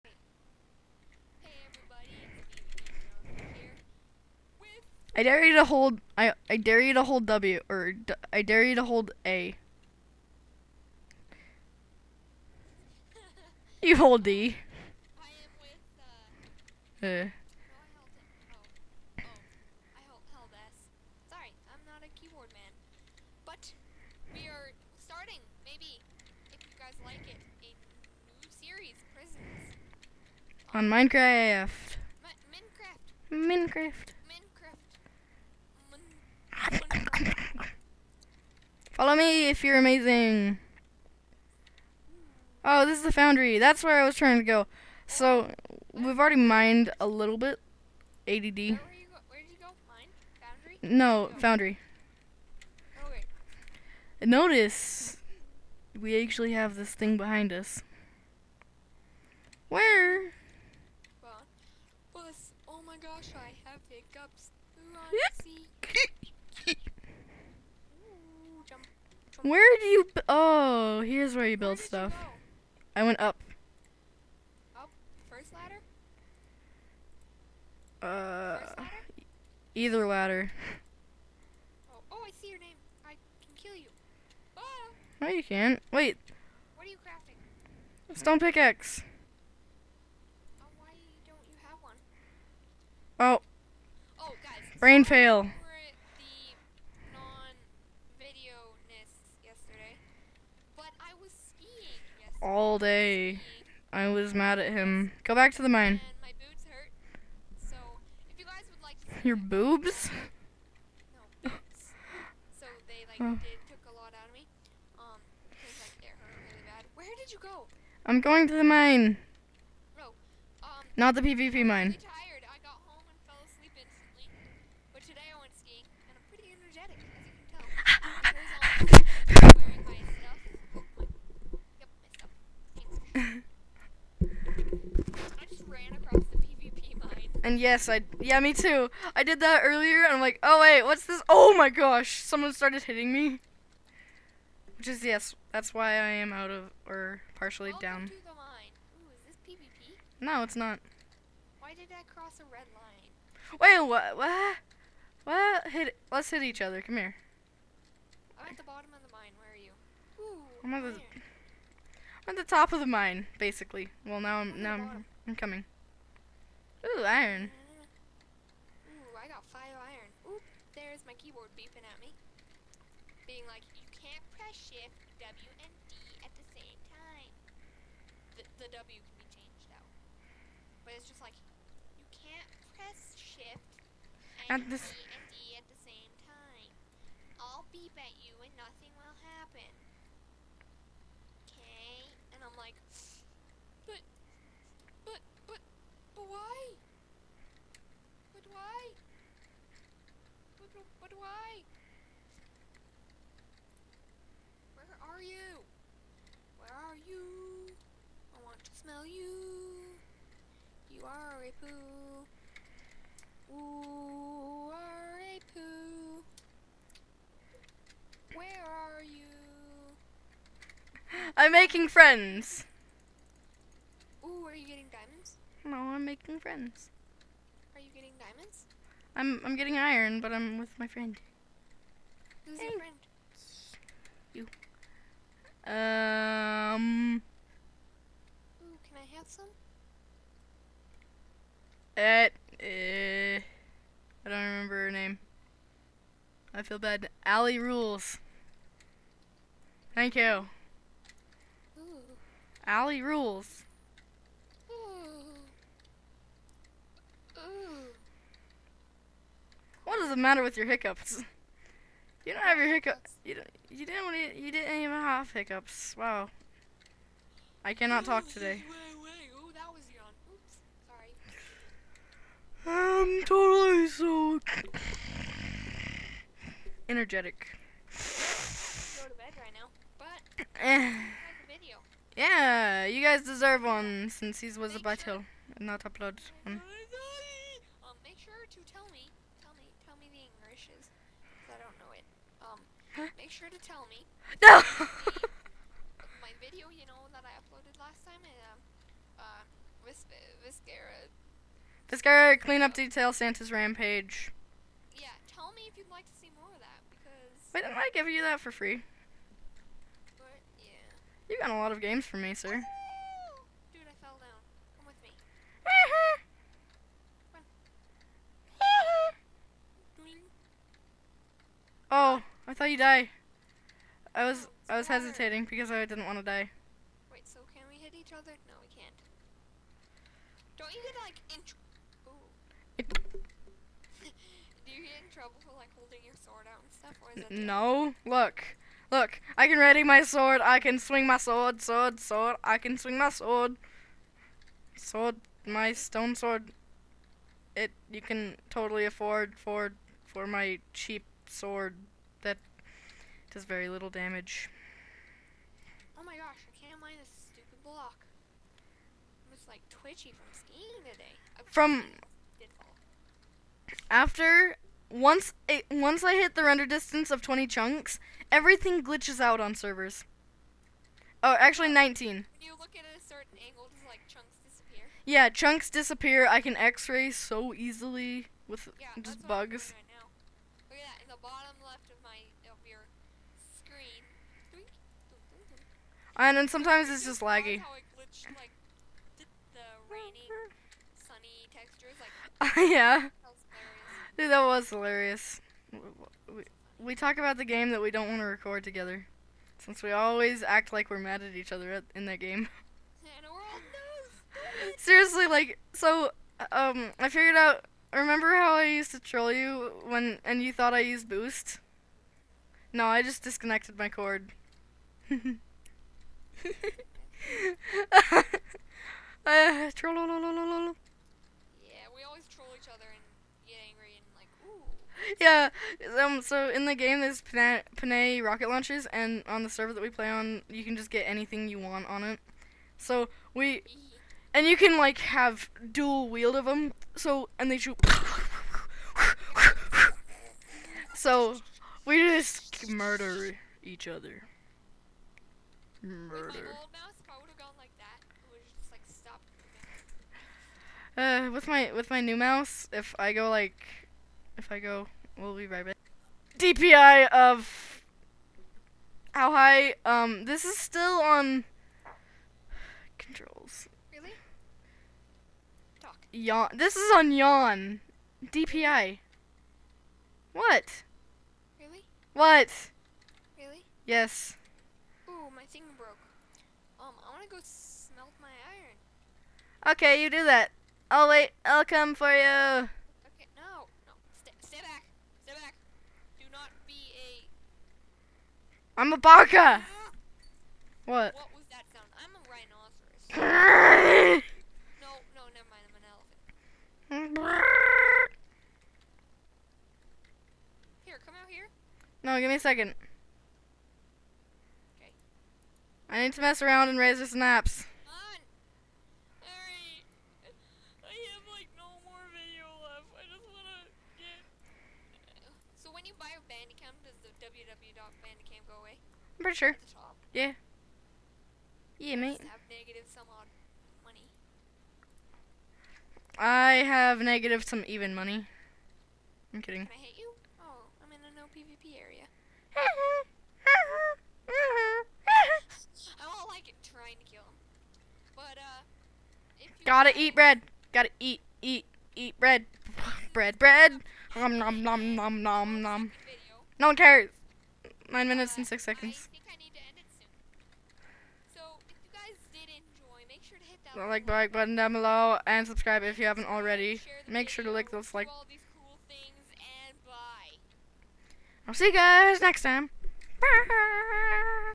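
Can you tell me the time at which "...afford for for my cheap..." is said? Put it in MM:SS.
05:48.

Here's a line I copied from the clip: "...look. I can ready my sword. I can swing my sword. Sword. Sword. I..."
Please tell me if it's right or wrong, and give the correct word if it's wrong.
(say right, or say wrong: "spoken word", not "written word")
right.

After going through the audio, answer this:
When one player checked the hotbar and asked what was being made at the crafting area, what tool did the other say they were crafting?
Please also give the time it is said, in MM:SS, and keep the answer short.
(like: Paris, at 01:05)
Stone pickaxe, at 01:28.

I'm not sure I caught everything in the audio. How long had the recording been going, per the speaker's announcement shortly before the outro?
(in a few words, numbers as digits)
9 minutes 6 seconds.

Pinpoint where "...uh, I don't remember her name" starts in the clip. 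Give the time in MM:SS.
04:02.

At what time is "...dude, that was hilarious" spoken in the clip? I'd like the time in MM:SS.
06:34.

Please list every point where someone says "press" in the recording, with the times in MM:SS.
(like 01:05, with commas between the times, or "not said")
02:54, 03:02.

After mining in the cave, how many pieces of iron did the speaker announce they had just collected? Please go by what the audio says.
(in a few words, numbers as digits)
5.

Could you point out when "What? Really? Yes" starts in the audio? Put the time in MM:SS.
07:52.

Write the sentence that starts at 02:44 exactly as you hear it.
Well, now I'm, I'm now I'm, I'm coming.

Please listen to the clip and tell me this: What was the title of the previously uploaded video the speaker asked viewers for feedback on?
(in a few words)
Santa's rampage.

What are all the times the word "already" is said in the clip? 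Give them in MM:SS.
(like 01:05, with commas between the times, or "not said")
00:46, 09:16.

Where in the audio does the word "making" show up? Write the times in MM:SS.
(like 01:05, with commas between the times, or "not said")
03:41, 03:46.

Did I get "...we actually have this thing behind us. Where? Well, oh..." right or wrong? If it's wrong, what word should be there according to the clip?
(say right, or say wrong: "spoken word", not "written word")
right.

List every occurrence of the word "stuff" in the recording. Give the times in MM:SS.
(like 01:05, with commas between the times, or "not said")
01:11, 05:36.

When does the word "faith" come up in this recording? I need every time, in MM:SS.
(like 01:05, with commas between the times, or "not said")
not said.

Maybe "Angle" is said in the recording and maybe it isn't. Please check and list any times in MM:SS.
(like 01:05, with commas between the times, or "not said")
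06:12.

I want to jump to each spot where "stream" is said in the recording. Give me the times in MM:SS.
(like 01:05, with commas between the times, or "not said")
not said.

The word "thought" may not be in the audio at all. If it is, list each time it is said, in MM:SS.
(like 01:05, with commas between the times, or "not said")
05:22, 06:50.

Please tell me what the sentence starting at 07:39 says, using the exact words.
Um, this is still on controls.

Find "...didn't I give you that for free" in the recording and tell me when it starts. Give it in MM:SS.
05:07.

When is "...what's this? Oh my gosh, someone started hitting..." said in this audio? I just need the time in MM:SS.
02:20.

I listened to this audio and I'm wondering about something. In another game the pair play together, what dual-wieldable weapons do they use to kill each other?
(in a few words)
Rocket launchers.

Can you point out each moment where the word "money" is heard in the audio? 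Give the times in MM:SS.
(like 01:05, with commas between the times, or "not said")
08:43, 08:47.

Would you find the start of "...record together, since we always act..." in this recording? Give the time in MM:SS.
06:38.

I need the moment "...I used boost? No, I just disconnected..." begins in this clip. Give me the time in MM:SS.
06:50.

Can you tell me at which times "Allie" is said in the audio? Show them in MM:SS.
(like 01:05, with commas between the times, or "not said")
04:07, 04:12.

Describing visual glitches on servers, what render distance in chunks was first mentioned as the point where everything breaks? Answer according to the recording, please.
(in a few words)
20 chunks.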